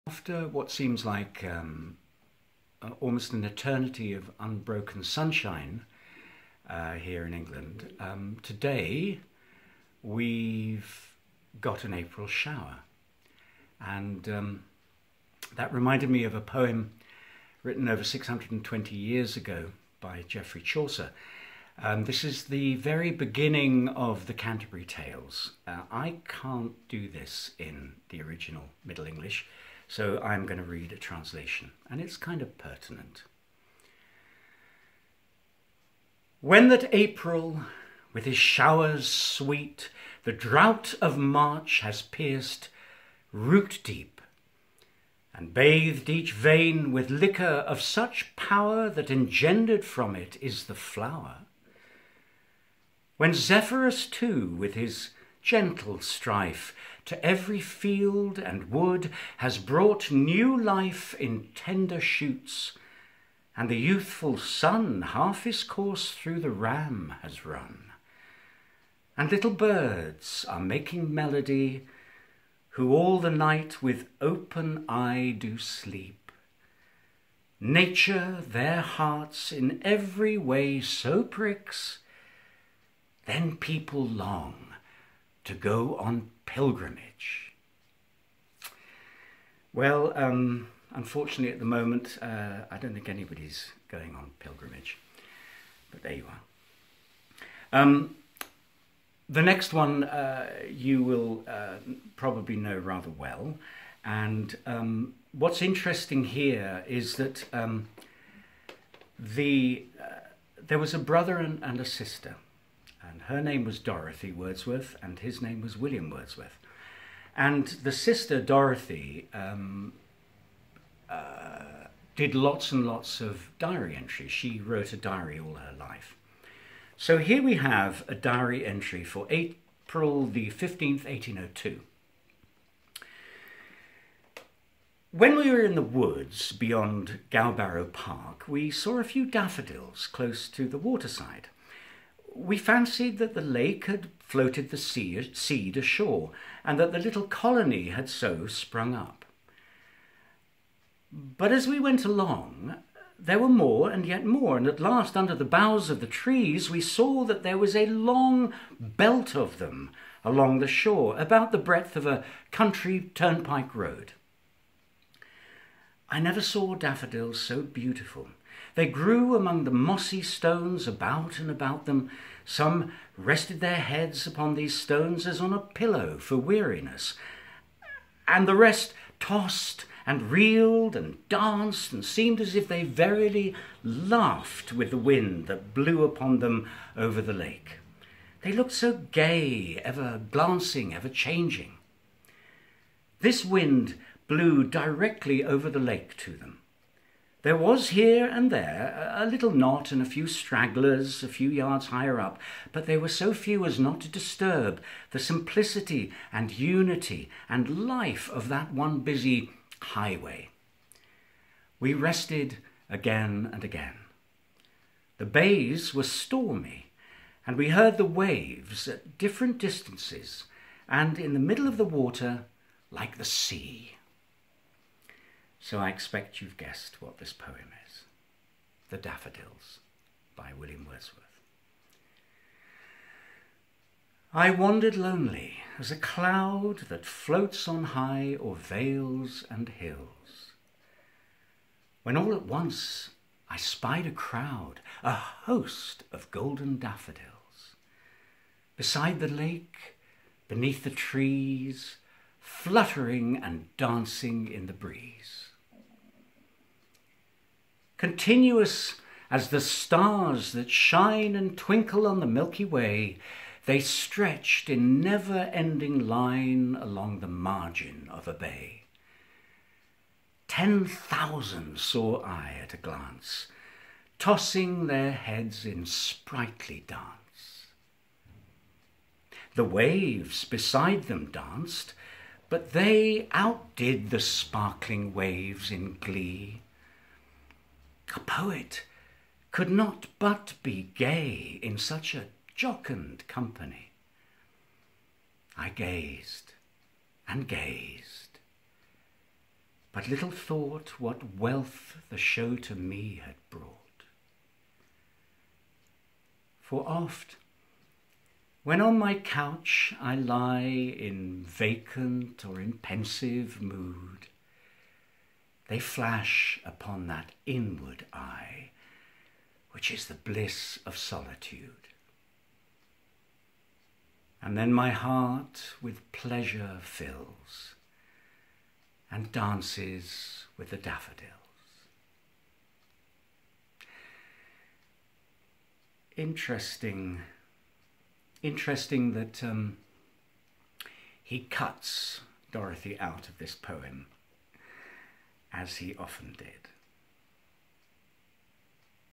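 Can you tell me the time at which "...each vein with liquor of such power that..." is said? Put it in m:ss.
0:46.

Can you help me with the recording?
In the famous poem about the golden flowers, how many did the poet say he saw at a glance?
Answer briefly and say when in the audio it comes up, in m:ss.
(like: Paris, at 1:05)
10,000, at 4:30.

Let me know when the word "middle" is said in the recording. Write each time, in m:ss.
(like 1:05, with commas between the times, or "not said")
0:28, 3:41.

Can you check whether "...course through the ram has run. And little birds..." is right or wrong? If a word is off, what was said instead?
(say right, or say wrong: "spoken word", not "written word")
right.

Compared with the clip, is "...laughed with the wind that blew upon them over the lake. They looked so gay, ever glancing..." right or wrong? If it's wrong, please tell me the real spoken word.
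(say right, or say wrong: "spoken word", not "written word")
right.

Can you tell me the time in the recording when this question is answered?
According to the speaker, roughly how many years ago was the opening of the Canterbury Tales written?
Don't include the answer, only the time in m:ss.
0:17.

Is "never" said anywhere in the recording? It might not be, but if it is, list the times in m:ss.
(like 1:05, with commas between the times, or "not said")
2:46, 4:24.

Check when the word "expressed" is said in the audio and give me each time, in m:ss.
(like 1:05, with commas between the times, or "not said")
not said.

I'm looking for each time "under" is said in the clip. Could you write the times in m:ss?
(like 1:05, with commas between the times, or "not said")
2:35.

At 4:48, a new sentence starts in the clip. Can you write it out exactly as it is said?
A poet could not but be gay in such a jocund company.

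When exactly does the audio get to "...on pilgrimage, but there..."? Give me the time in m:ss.
1:34.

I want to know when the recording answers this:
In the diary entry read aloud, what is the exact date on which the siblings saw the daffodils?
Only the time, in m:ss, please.
2:09.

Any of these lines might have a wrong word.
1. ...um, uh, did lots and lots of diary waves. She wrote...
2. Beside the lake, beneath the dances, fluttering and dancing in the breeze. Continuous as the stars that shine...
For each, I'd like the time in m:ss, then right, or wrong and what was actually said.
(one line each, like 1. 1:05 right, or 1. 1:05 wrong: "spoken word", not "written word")
1. 1:59 wrong: "entries", not "waves"
2. 4:08 wrong: "trees", not "dances".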